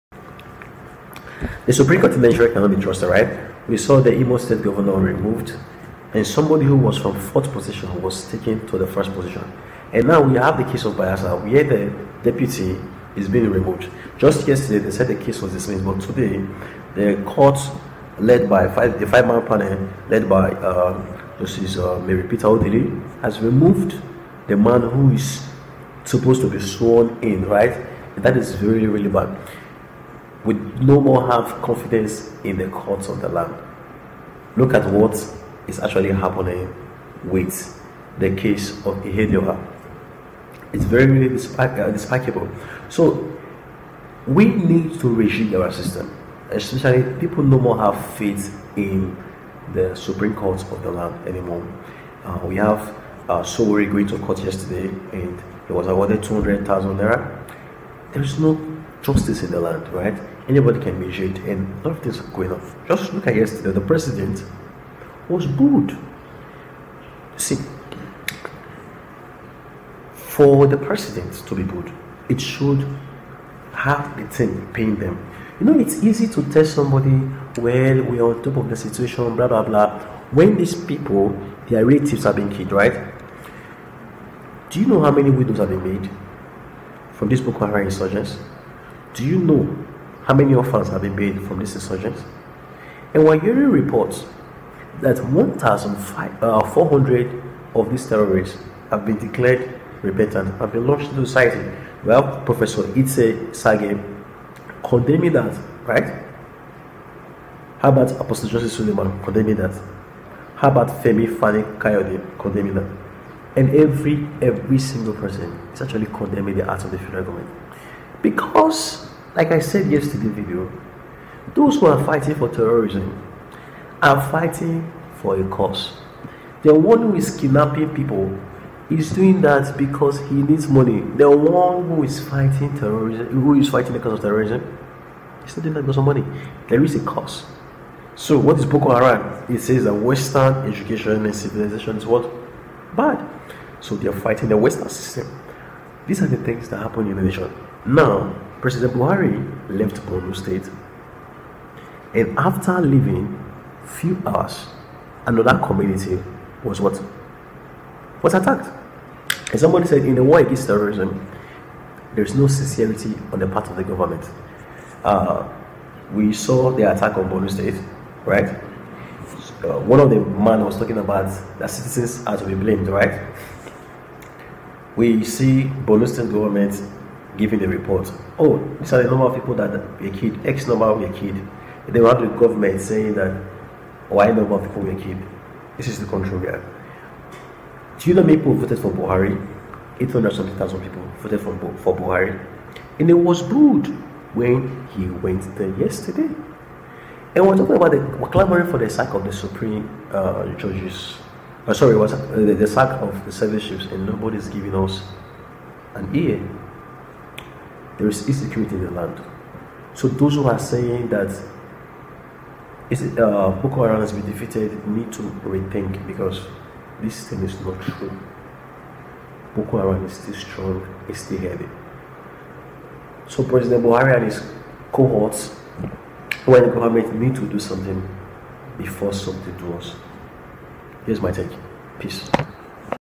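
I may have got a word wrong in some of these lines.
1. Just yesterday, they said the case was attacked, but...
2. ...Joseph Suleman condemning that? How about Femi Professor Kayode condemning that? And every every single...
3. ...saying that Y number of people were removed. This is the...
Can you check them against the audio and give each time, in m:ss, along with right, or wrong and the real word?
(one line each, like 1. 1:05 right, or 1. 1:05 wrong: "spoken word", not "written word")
1. 0:14 wrong: "dismissed", not "attacked"
2. 1:48 wrong: "Fani", not "Professor"
3. 3:02 wrong: "killed", not "removed".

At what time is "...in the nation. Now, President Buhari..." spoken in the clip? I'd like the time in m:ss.
2:27.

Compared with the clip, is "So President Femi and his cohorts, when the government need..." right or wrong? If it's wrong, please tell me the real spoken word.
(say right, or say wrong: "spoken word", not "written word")
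wrong: "Buhari", not "Femi".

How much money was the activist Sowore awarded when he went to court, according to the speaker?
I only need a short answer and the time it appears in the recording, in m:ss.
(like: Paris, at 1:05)
200,000 naira, at 0:56.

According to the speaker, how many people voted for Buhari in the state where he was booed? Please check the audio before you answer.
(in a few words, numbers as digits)
800,000.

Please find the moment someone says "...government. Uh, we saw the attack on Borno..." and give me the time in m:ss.
2:43.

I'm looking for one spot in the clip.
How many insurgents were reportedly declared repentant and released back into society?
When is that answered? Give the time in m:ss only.
1:35.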